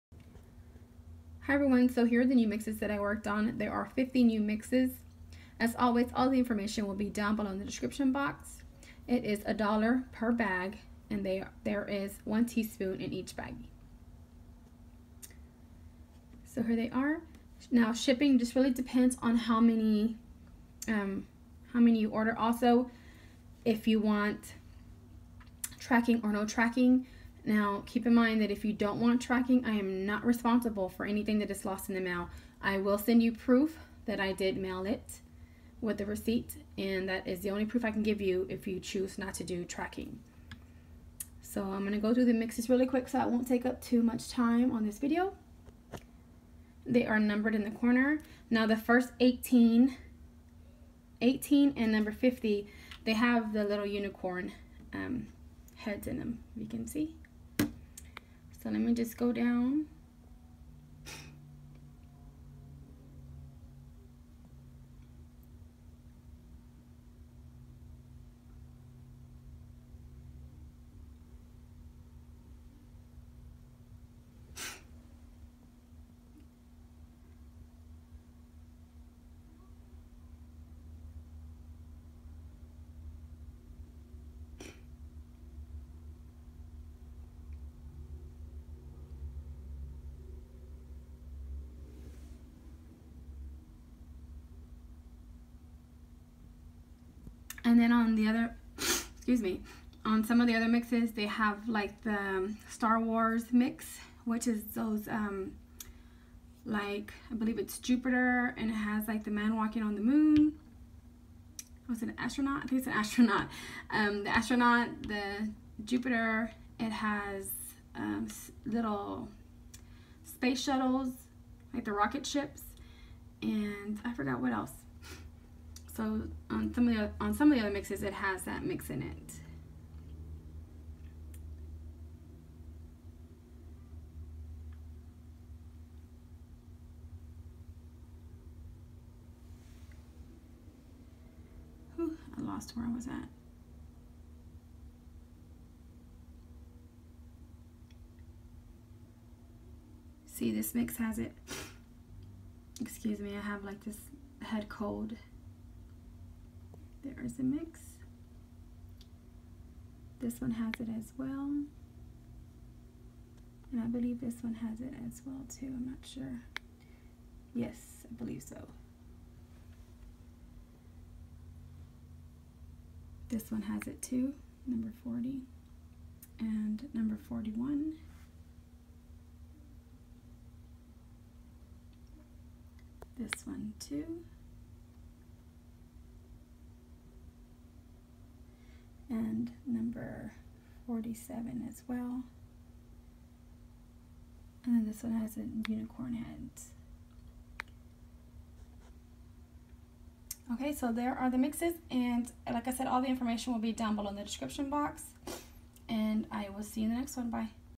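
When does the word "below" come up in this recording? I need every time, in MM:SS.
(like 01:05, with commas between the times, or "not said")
00:07, 03:23.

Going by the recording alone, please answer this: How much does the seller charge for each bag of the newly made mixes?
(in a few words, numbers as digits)
$1.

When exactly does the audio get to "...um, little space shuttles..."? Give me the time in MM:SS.
01:57.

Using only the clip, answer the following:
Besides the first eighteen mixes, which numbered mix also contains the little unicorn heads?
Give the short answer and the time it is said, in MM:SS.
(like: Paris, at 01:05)
50, at 00:51.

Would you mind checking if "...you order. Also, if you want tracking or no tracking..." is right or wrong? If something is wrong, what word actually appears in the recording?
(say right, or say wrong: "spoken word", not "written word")
right.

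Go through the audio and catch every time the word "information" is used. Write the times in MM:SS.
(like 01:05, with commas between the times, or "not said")
00:06, 03:23.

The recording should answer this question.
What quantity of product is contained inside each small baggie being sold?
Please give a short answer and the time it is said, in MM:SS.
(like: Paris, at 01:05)
1 teaspoon, at 00:12.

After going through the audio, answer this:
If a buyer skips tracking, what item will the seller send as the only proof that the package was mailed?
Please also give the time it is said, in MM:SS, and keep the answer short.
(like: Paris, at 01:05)
the receipt, at 00:36.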